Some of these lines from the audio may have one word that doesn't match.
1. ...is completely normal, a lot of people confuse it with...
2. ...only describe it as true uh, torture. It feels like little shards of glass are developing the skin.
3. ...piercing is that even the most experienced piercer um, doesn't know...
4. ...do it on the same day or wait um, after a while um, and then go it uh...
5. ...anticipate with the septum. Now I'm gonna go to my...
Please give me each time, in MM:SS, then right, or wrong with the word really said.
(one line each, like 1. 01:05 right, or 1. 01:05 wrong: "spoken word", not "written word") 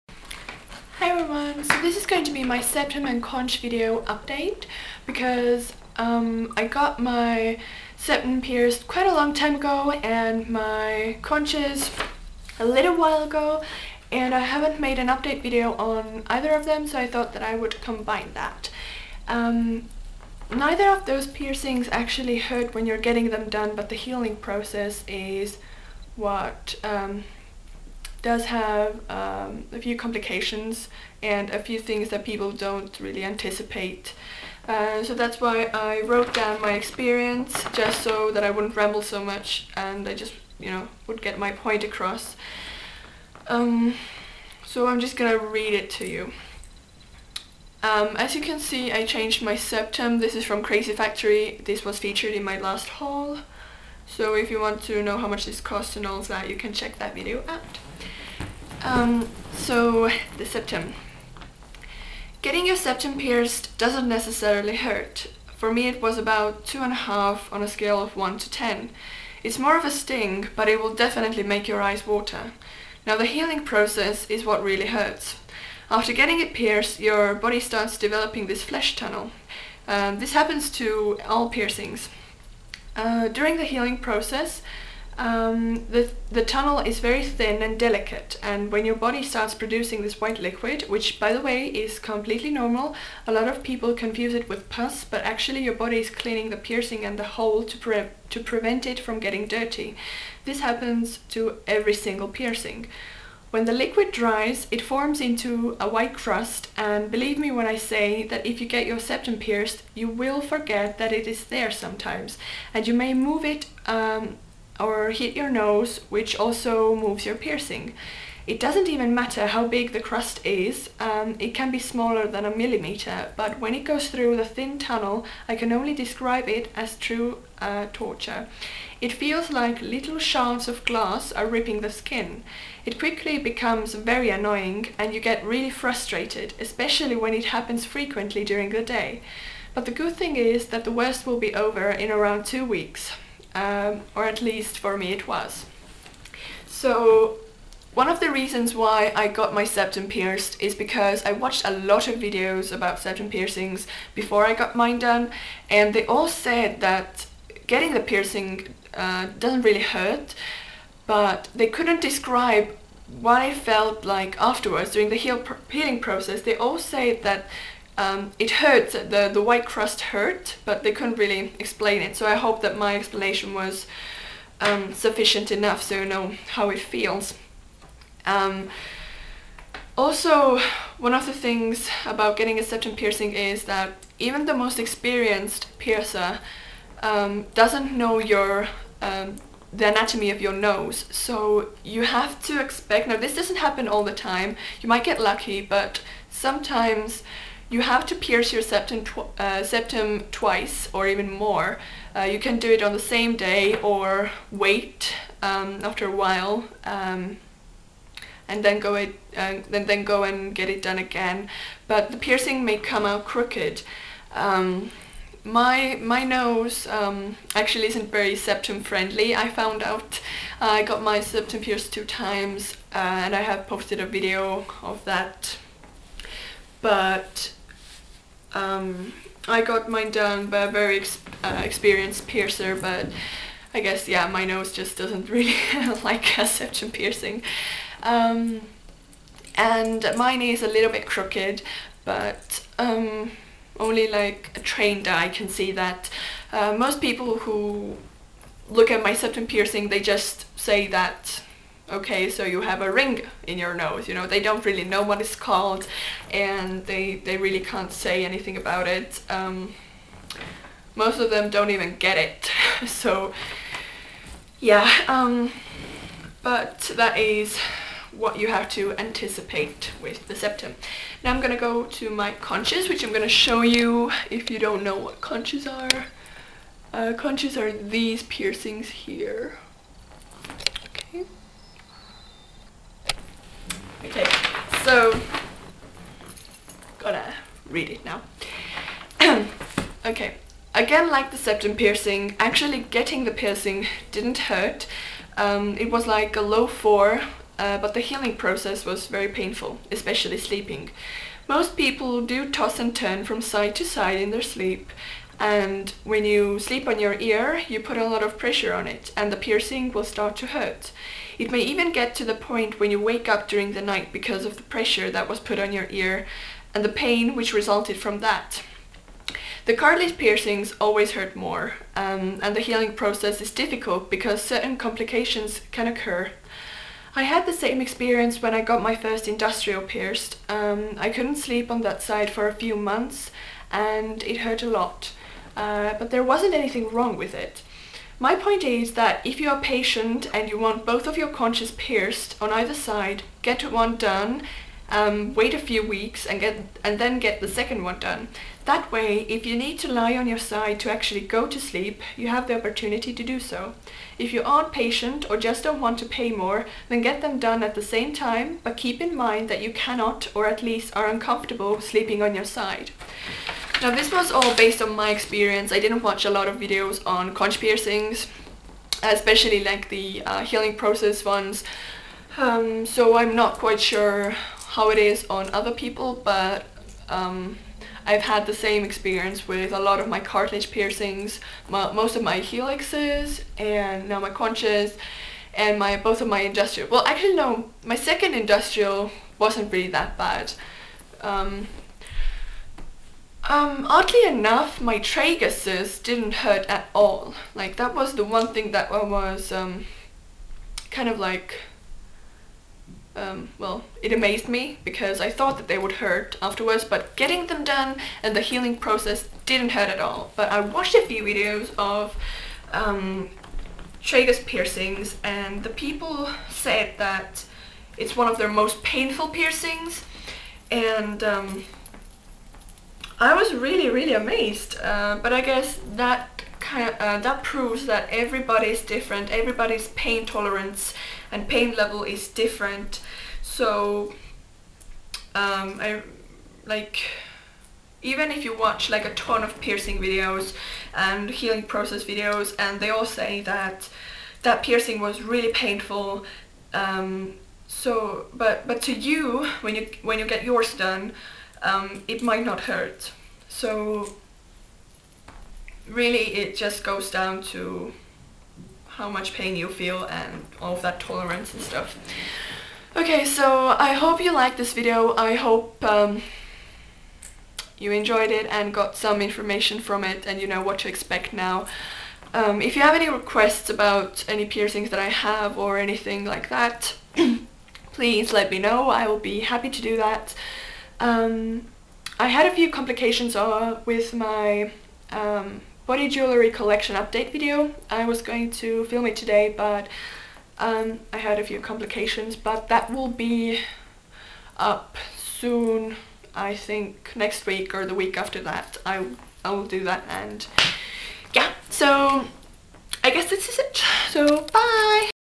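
1. 01:31 right
2. 02:05 wrong: "ripping", not "developing"
3. 03:02 right
4. 03:22 right
5. 04:28 right.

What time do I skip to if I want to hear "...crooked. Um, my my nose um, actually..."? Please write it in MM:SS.
03:33.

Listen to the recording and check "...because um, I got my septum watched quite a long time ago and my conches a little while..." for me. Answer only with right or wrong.
wrong.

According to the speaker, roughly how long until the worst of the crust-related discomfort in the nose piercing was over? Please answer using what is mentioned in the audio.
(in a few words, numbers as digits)
2 weeks.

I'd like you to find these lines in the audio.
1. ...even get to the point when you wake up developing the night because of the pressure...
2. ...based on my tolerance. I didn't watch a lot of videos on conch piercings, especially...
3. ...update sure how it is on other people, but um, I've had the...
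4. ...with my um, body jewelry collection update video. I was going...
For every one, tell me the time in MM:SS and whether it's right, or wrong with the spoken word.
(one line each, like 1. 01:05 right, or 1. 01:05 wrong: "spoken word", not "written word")
1. 05:11 wrong: "during", not "developing"
2. 06:04 wrong: "experience", not "tolerance"
3. 06:13 wrong: "quite", not "update"
4. 08:03 right.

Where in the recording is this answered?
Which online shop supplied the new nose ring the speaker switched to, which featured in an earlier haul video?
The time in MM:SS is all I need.
00:50.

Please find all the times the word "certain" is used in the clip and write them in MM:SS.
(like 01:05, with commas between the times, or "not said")
05:24.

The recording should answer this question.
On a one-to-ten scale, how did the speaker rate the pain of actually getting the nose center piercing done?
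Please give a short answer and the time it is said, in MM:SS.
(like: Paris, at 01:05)
2.5, at 01:06.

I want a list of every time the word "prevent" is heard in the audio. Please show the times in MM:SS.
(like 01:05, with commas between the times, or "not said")
01:38.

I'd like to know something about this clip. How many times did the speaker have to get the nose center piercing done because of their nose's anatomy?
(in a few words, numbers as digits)
2.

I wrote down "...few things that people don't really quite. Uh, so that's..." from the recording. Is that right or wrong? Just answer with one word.
wrong.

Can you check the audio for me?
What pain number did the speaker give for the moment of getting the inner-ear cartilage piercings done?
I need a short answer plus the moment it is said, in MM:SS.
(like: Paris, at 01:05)
4, at 04:56.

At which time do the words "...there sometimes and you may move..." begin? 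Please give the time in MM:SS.
01:51.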